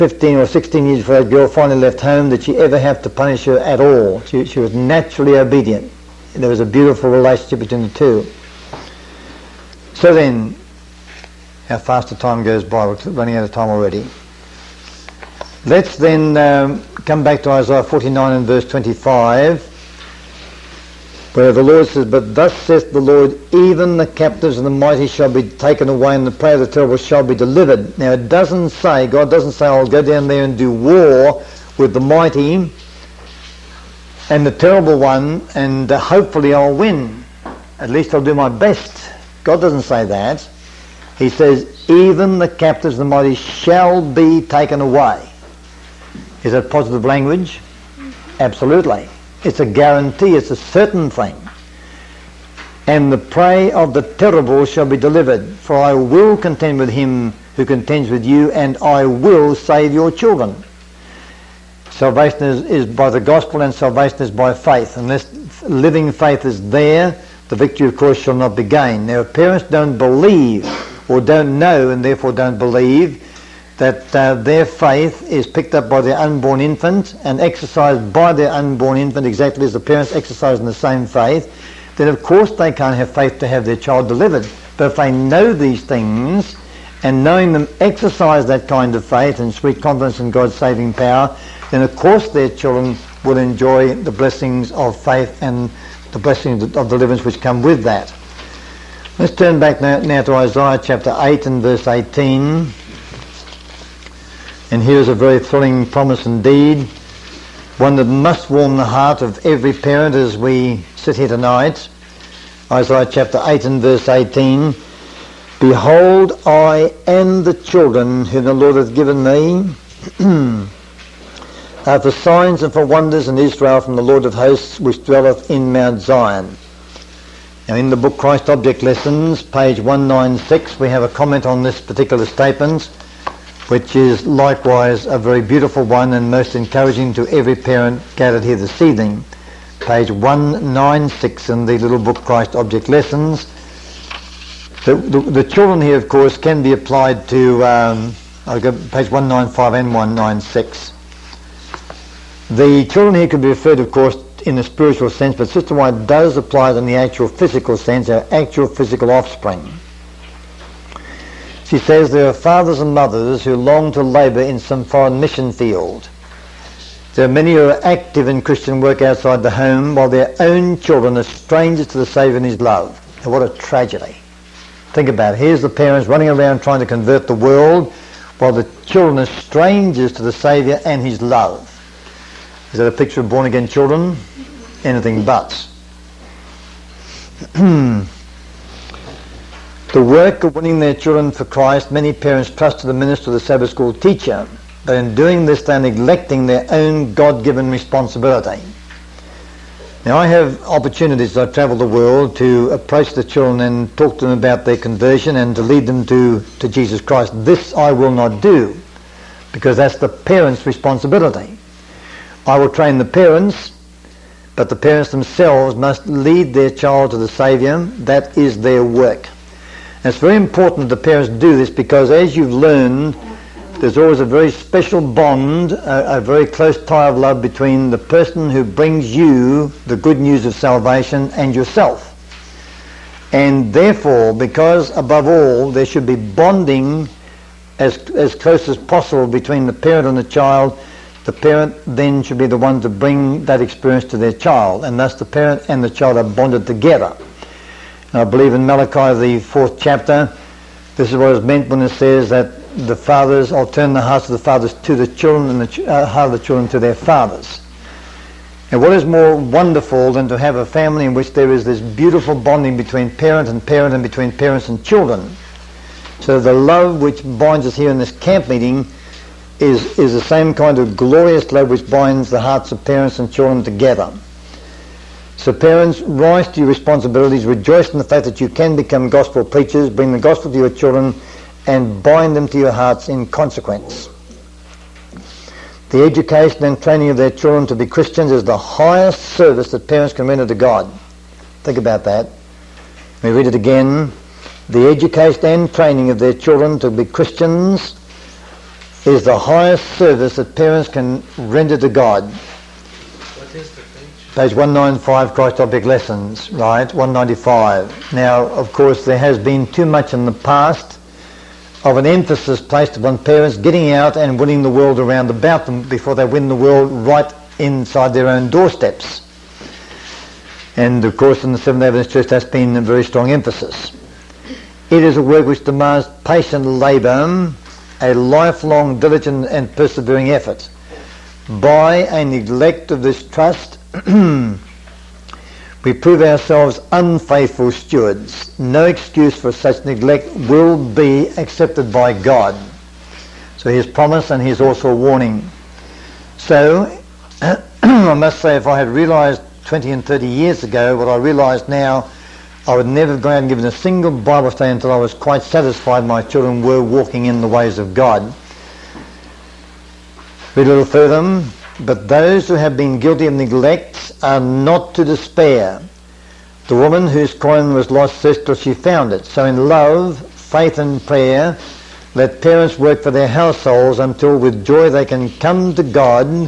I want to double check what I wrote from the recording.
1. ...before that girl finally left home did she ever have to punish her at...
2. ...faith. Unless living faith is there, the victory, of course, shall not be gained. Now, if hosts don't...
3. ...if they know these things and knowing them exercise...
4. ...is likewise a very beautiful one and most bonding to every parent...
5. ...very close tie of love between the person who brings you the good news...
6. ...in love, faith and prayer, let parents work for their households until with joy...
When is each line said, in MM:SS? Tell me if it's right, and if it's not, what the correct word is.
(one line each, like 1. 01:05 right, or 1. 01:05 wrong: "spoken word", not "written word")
1. 00:00 right
2. 01:04 wrong: "parents", not "hosts"
3. 01:24 right
4. 02:13 wrong: "encouraging", not "bonding"
5. 03:46 right
6. 06:09 right.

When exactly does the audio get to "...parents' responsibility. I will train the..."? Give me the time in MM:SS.
03:30.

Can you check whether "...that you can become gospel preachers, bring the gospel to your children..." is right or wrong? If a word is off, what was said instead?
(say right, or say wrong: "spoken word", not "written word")
right.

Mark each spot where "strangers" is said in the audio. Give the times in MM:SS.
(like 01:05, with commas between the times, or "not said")
02:51, 02:59.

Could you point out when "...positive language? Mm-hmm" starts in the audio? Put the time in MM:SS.
00:46.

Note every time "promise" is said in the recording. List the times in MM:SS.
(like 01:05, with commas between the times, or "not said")
01:45, 05:43.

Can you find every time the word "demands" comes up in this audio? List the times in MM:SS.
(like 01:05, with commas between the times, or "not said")
05:25.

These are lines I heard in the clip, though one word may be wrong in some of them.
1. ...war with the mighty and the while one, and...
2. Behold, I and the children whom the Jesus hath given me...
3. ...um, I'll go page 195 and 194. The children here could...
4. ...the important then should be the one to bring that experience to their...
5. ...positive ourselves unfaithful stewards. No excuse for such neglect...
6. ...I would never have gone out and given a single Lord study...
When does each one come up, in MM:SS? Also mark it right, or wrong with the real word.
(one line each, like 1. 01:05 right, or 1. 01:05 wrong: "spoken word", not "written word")
1. 00:30 wrong: "terrible", not "while"
2. 01:55 wrong: "Lord", not "Jesus"
3. 02:27 wrong: "196", not "194"
4. 04:01 wrong: "parent", not "important"
5. 05:35 wrong: "prove", not "positive"
6. 05:52 wrong: "Bible", not "Lord".